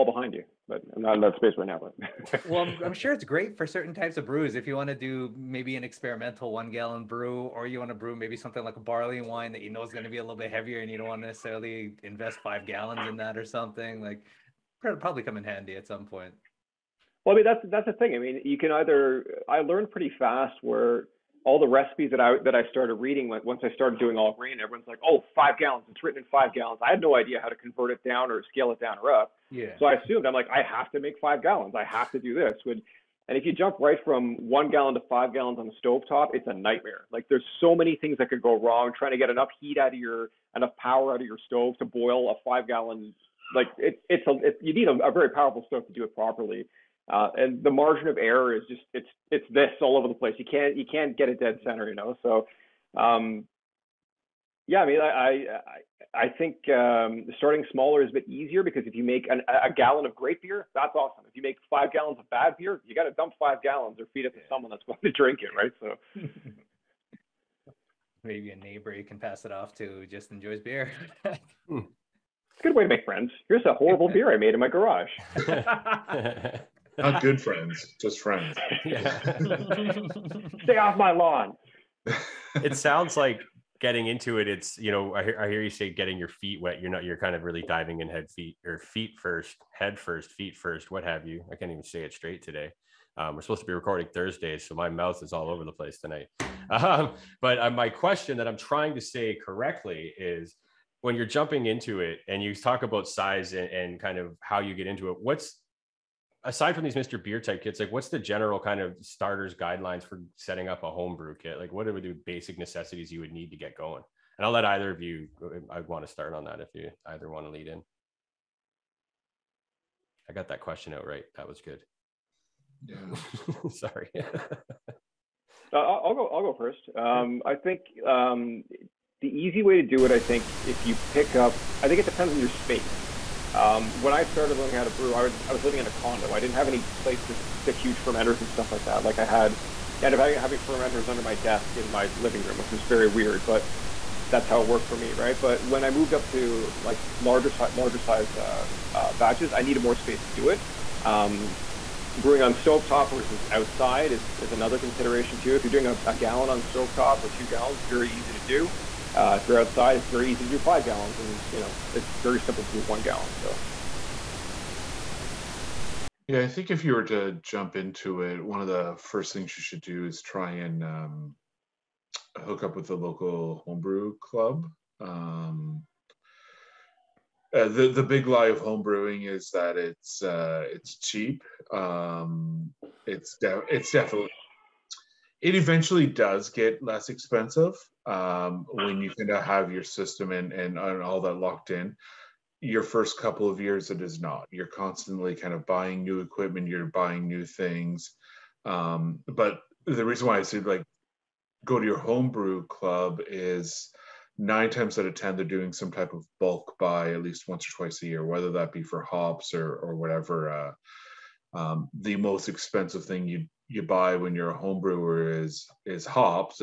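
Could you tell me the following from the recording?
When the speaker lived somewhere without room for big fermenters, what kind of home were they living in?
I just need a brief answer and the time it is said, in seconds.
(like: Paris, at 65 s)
condo, at 135 s.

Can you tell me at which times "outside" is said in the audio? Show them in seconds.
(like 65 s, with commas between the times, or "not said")
153 s, 159 s.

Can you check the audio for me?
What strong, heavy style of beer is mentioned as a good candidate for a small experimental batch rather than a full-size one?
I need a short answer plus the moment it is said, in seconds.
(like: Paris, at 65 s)
barley wine, at 8 s.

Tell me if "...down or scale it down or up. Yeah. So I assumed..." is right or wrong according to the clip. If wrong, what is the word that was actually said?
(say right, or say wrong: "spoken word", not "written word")
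right.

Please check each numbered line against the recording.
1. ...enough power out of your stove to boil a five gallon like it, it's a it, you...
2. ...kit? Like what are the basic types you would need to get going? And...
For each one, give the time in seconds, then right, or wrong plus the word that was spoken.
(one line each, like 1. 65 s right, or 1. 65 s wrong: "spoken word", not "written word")
1. 40 s right
2. 111 s wrong: "necessities", not "types".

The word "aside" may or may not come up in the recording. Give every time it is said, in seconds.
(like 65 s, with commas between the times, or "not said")
106 s.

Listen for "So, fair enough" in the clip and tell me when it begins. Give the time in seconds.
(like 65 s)
163 s.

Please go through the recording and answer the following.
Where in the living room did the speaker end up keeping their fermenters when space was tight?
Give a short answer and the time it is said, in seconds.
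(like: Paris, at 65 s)
under my desk, at 141 s.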